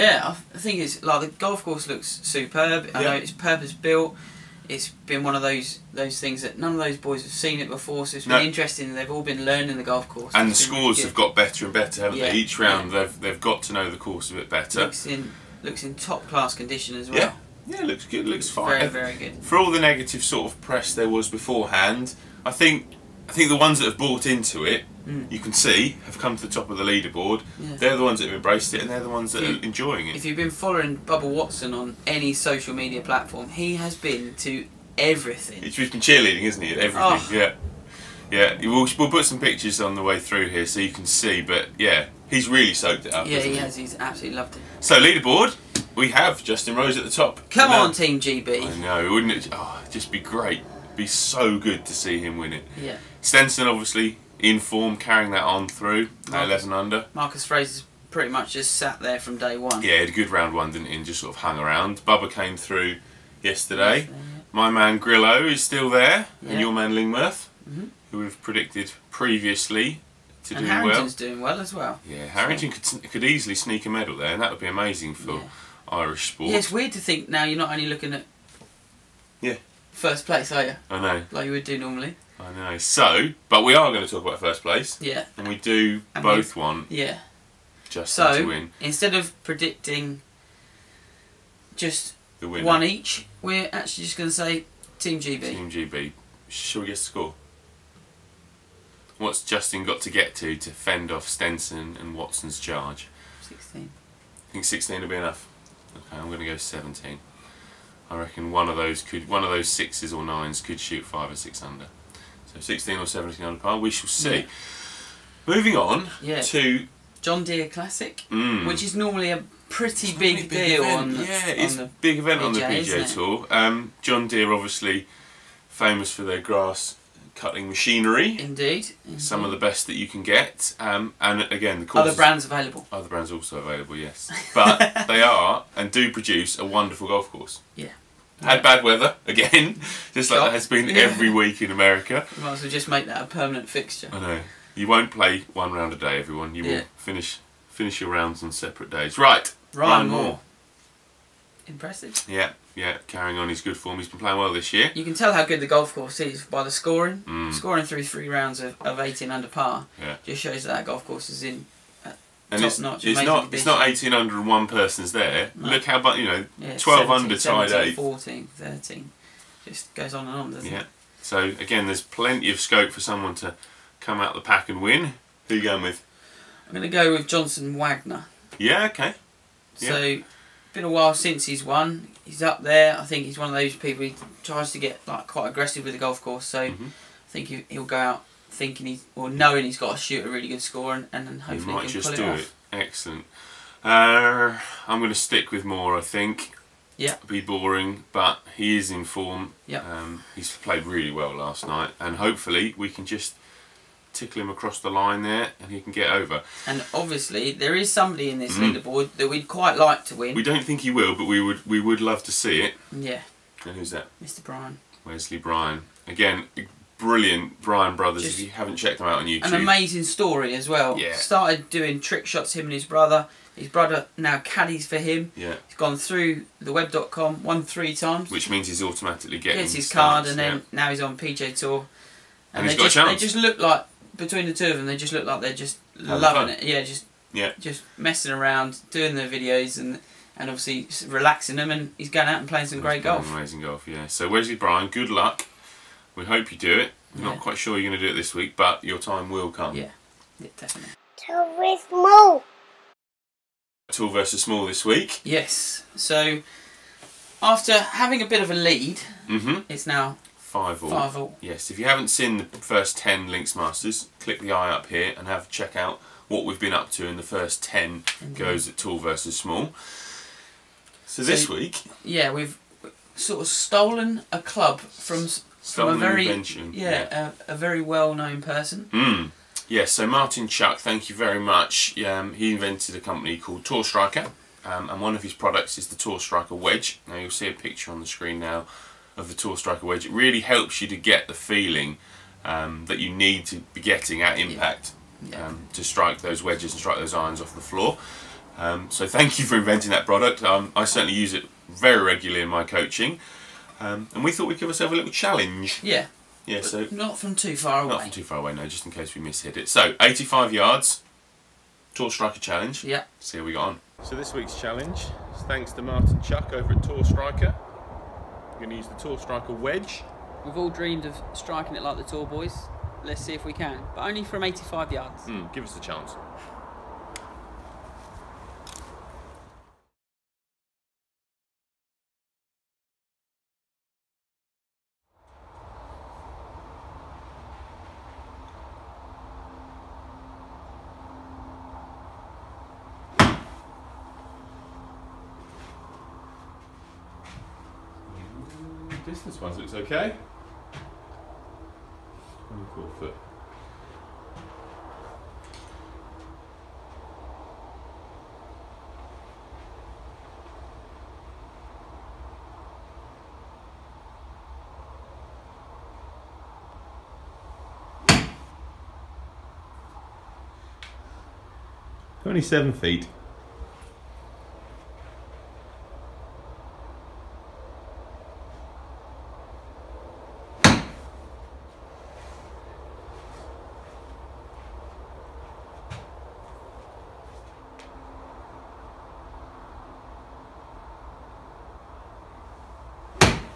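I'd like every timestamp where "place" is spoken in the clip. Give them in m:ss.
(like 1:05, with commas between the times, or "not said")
1:20, 1:24.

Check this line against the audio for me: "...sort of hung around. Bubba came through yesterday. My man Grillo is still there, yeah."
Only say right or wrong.
right.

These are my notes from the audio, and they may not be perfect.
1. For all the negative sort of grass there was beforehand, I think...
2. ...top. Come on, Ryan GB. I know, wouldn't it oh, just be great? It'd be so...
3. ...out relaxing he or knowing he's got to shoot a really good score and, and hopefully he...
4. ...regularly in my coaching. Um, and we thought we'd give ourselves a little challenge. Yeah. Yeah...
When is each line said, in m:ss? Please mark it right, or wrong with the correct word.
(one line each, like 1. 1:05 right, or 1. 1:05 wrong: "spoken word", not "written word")
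1. 0:19 wrong: "press", not "grass"
2. 0:47 wrong: "Team", not "Ryan"
3. 3:07 wrong: "thinking", not "relaxing"
4. 5:02 right.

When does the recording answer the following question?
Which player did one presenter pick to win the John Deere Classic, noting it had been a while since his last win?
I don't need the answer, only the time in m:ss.
2:57.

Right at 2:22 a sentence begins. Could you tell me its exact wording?
We might as well just make that a permanent fixture.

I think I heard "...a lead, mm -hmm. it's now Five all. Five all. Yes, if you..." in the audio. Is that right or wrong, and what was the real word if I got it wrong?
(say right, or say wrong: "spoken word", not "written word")
right.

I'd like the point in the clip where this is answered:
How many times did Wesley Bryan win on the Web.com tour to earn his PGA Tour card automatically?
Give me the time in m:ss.
3:47.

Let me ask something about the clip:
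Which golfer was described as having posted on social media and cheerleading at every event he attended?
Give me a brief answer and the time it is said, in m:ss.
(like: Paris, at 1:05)
Bubba Watson, at 0:30.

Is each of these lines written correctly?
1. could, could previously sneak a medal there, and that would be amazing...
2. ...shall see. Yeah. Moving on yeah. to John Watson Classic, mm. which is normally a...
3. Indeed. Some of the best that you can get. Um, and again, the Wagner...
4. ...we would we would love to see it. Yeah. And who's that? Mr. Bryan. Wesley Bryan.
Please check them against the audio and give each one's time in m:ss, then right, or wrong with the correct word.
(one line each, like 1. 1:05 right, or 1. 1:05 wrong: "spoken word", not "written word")
1. 1:12 wrong: "easily", not "previously"
2. 1:53 wrong: "Deere", not "Watson"
3. 2:08 wrong: "Other", not "Wagner"
4. 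3:31 right.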